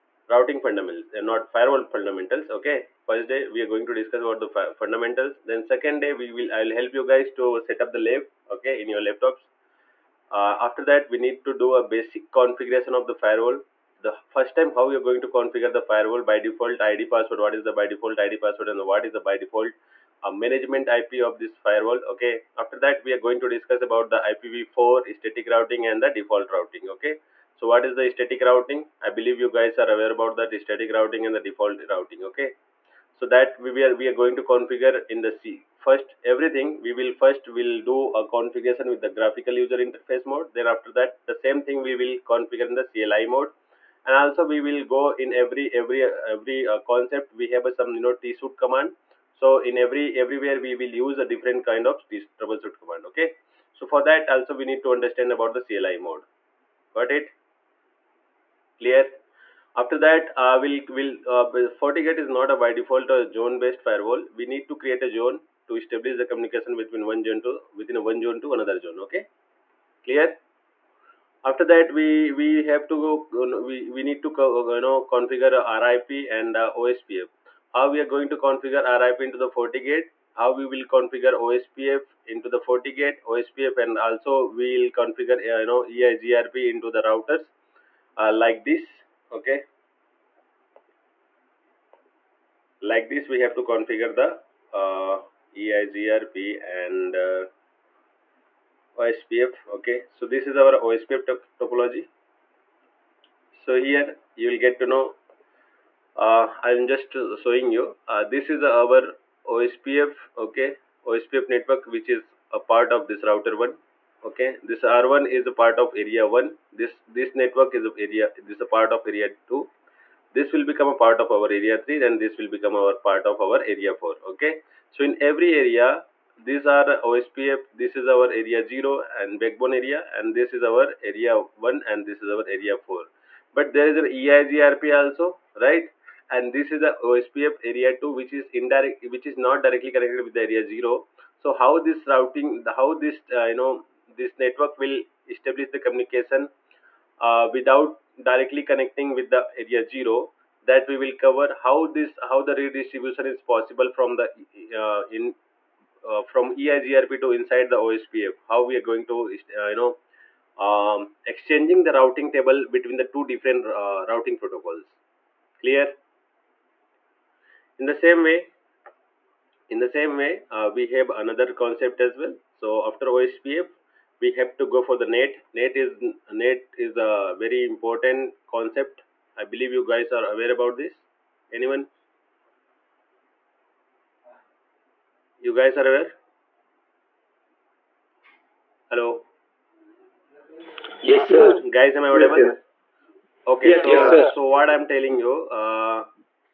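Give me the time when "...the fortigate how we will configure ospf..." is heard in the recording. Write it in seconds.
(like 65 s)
79 s.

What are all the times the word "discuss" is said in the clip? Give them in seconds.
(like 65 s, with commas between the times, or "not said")
3 s, 23 s.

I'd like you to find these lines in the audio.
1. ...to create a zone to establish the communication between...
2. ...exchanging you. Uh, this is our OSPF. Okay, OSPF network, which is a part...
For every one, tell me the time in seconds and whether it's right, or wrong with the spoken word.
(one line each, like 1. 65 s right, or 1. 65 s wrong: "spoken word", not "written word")
1. 64 s right
2. 107 s wrong: "showing", not "exchanging".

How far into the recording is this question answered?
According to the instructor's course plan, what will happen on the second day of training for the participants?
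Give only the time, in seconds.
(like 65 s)
7 s.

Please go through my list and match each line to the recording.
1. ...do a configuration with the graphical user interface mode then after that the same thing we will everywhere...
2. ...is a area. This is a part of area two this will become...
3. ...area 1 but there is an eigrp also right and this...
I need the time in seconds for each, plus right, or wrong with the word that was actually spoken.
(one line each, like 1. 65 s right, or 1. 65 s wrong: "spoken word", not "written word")
1. 37 s wrong: "configure", not "everywhere"
2. 117 s right
3. 132 s wrong: "4", not "1".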